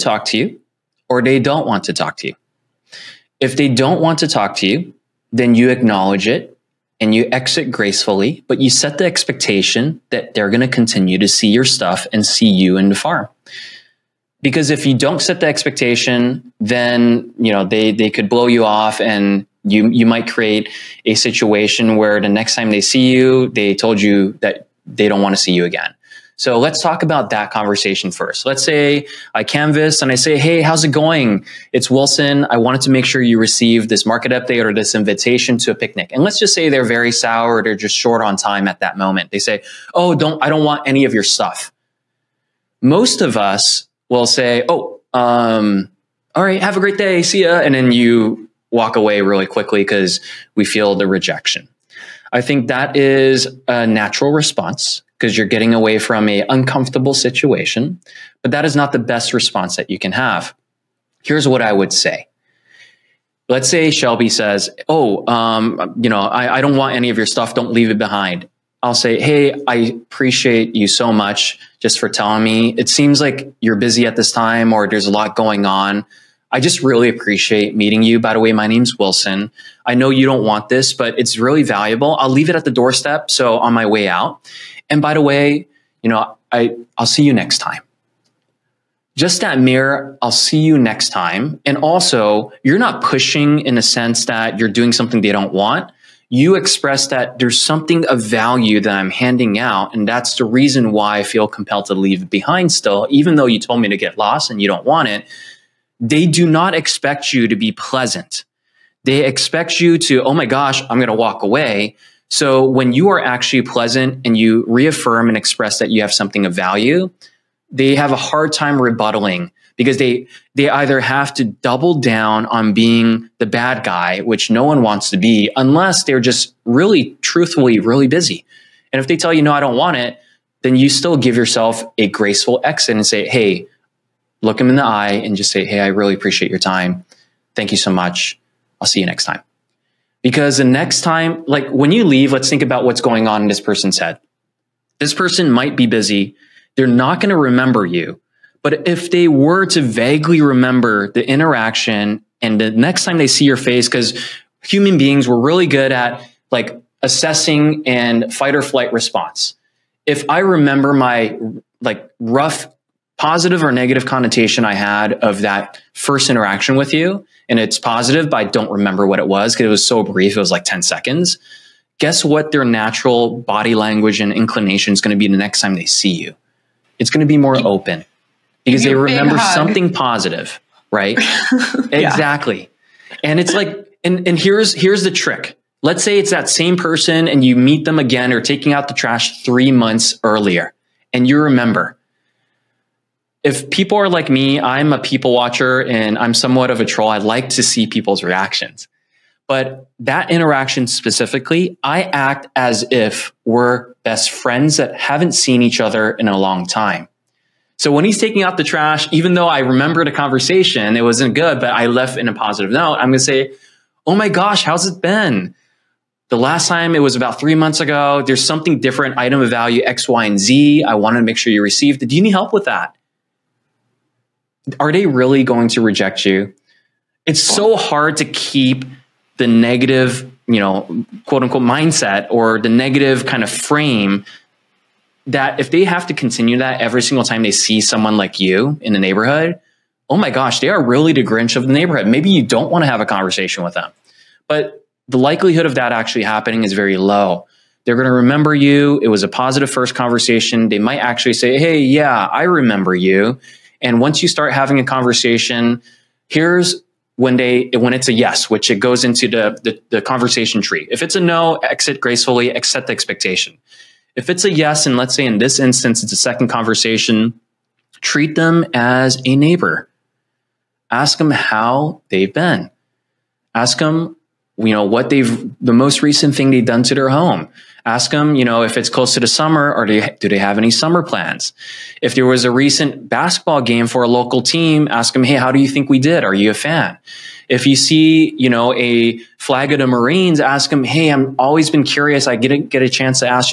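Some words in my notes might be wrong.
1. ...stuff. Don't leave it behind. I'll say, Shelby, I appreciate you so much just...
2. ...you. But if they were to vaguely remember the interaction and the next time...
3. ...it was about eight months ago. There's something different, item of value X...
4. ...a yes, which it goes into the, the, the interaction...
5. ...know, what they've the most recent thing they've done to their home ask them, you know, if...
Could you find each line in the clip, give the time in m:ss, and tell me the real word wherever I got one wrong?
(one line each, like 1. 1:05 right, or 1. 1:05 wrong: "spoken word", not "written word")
1. 1:07 wrong: "Hey", not "Shelby"
2. 2:27 right
3. 3:36 wrong: "three", not "eight"
4. 4:18 wrong: "conversation", not "interaction"
5. 4:34 right.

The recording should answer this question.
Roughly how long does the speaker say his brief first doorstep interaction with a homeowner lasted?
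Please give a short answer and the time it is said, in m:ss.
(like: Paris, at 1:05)
10 seconds, at 2:50.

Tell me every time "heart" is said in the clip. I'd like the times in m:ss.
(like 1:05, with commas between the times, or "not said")
not said.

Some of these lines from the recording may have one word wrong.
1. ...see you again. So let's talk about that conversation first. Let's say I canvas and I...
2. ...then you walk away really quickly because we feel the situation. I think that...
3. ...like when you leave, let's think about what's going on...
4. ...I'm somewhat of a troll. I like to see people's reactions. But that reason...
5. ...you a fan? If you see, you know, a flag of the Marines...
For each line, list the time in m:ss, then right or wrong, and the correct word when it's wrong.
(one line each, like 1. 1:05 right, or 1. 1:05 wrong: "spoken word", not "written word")
1. 0:25 right
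2. 0:47 wrong: "rejection", not "situation"
3. 2:21 right
4. 3:16 wrong: "interaction", not "reason"
5. 4:46 right.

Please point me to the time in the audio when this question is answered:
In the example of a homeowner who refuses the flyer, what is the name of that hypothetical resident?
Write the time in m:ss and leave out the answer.
1:03.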